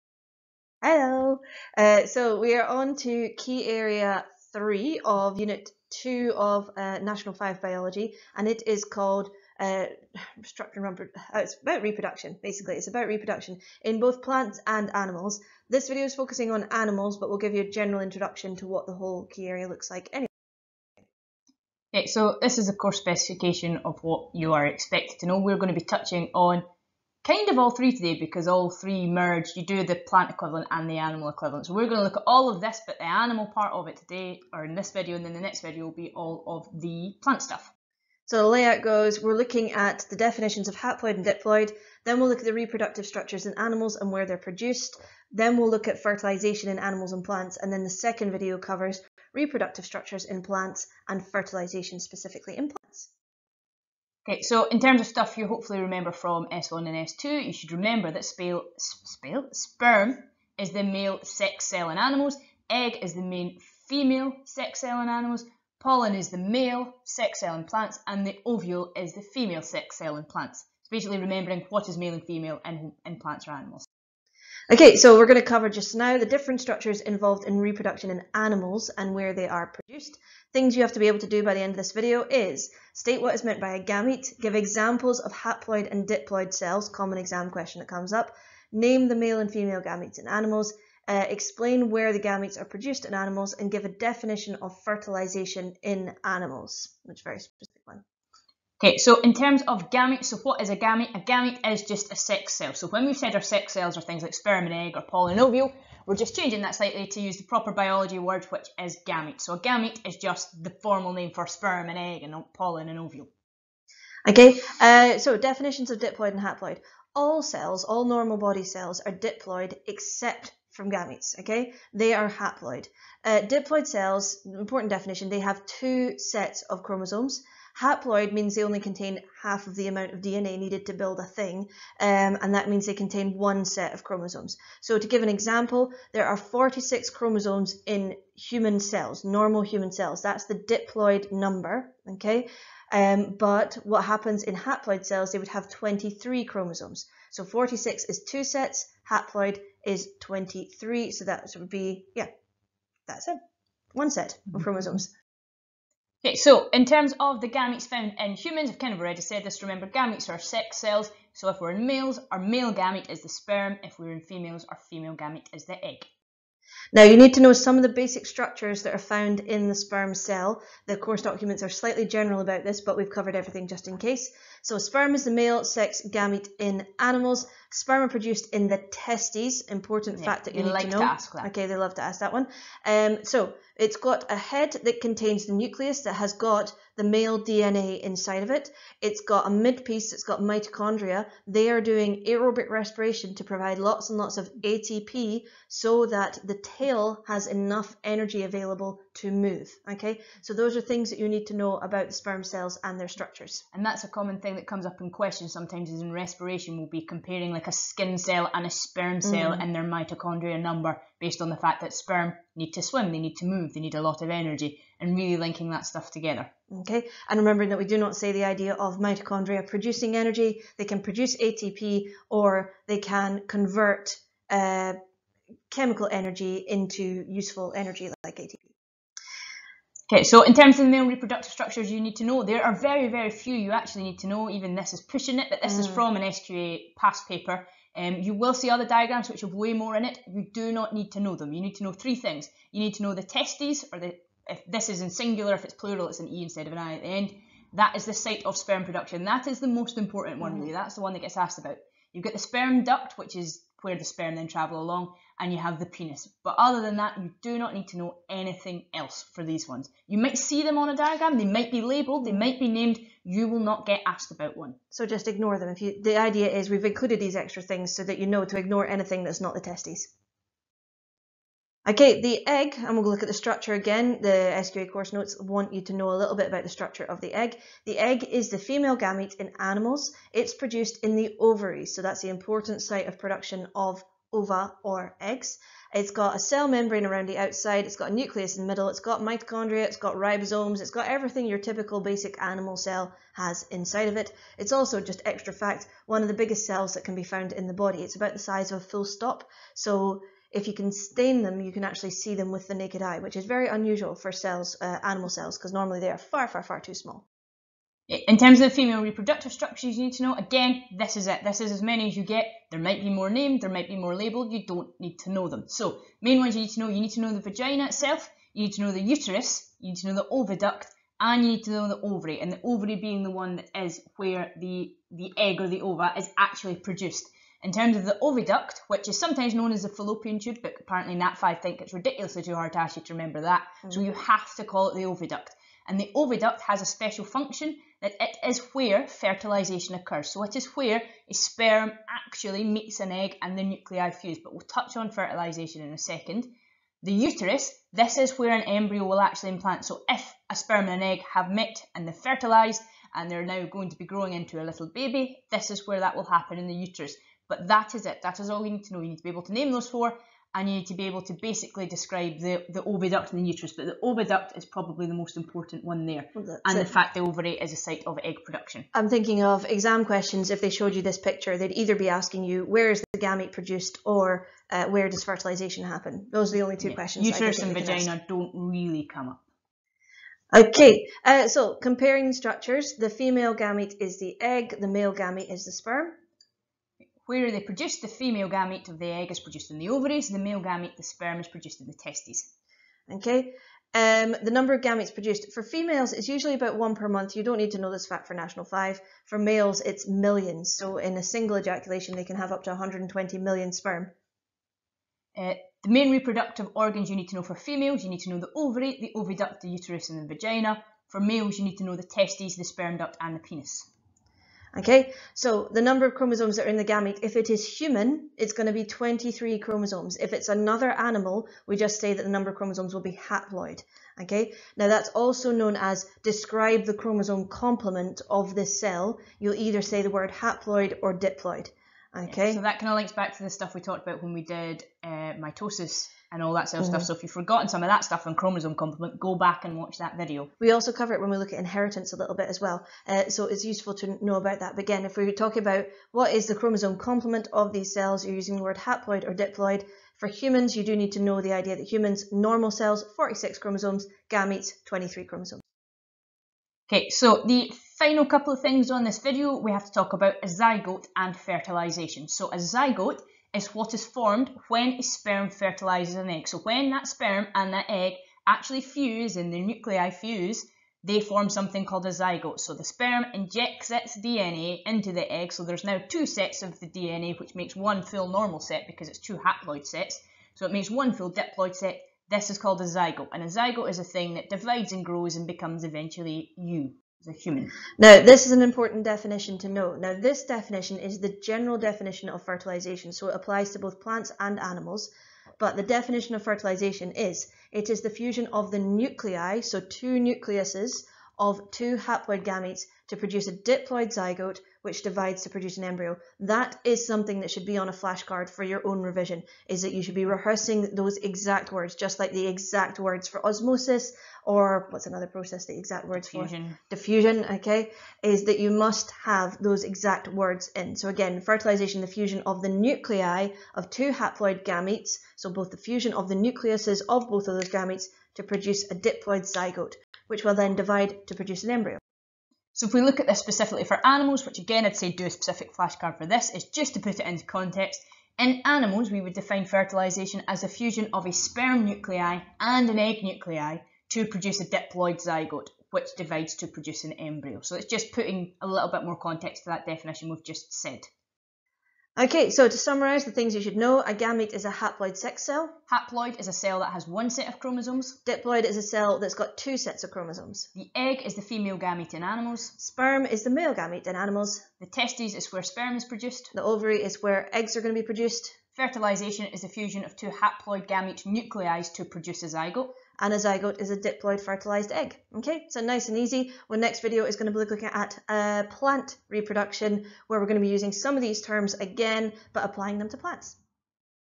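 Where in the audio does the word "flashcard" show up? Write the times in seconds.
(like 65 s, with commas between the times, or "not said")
508 s, 535 s.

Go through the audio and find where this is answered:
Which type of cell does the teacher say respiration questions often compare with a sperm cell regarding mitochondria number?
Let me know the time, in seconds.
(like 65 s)
207 s.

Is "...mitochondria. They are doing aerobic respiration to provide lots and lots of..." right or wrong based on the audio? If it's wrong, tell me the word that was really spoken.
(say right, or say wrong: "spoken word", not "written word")
right.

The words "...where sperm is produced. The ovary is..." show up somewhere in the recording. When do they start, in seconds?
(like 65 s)
565 s.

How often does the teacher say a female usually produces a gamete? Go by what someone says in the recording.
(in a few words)
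About one per month.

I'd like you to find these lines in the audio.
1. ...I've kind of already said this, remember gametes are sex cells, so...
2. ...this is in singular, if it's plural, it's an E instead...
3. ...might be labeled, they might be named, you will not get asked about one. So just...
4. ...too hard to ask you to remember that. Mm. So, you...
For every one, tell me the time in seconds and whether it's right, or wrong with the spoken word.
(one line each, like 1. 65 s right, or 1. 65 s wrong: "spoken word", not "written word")
1. 158 s right
2. 244 s right
3. 261 s right
4. 332 s right.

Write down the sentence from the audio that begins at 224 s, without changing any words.
Uh, chemical energy into useful energy like ATP.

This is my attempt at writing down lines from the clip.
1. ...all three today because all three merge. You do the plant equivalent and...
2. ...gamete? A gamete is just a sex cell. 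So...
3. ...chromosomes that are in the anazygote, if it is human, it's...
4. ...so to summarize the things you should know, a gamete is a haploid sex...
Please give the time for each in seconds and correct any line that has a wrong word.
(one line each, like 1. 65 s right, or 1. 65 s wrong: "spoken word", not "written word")
1. 27 s right
2. 100 s right
3. 416 s wrong: "gamete", not "anazygote"
4. 552 s right.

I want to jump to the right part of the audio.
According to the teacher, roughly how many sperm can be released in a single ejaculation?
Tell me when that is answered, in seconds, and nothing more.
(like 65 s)
402 s.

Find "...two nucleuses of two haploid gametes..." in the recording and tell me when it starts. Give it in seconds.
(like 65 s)
499 s.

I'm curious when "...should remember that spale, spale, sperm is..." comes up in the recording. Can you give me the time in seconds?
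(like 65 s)
57 s.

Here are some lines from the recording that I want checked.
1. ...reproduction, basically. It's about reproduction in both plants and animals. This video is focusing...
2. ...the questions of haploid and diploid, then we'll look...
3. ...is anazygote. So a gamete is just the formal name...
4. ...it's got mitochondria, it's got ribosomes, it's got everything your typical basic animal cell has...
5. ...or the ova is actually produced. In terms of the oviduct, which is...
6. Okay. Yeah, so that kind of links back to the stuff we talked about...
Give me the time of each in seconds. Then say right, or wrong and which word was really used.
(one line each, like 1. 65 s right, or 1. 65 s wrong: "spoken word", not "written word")
1. 11 s right
2. 40 s wrong: "definitions", not "questions"
3. 108 s wrong: "gamete", not "anazygote"
4. 288 s right
5. 325 s right
6. 432 s right.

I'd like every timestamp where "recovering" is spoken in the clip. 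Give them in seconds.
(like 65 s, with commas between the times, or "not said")
not said.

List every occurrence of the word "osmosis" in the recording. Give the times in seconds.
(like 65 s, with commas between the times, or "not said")
513 s.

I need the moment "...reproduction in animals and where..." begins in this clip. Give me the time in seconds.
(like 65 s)
77 s.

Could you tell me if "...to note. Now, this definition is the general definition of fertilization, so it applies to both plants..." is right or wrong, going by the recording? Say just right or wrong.
right.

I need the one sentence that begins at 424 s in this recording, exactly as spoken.
Okay, now that's also known as describe the chromosome complement of this cell.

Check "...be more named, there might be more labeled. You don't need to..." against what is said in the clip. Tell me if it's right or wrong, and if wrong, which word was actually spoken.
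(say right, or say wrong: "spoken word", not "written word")
right.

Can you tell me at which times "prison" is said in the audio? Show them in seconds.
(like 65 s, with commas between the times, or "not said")
not said.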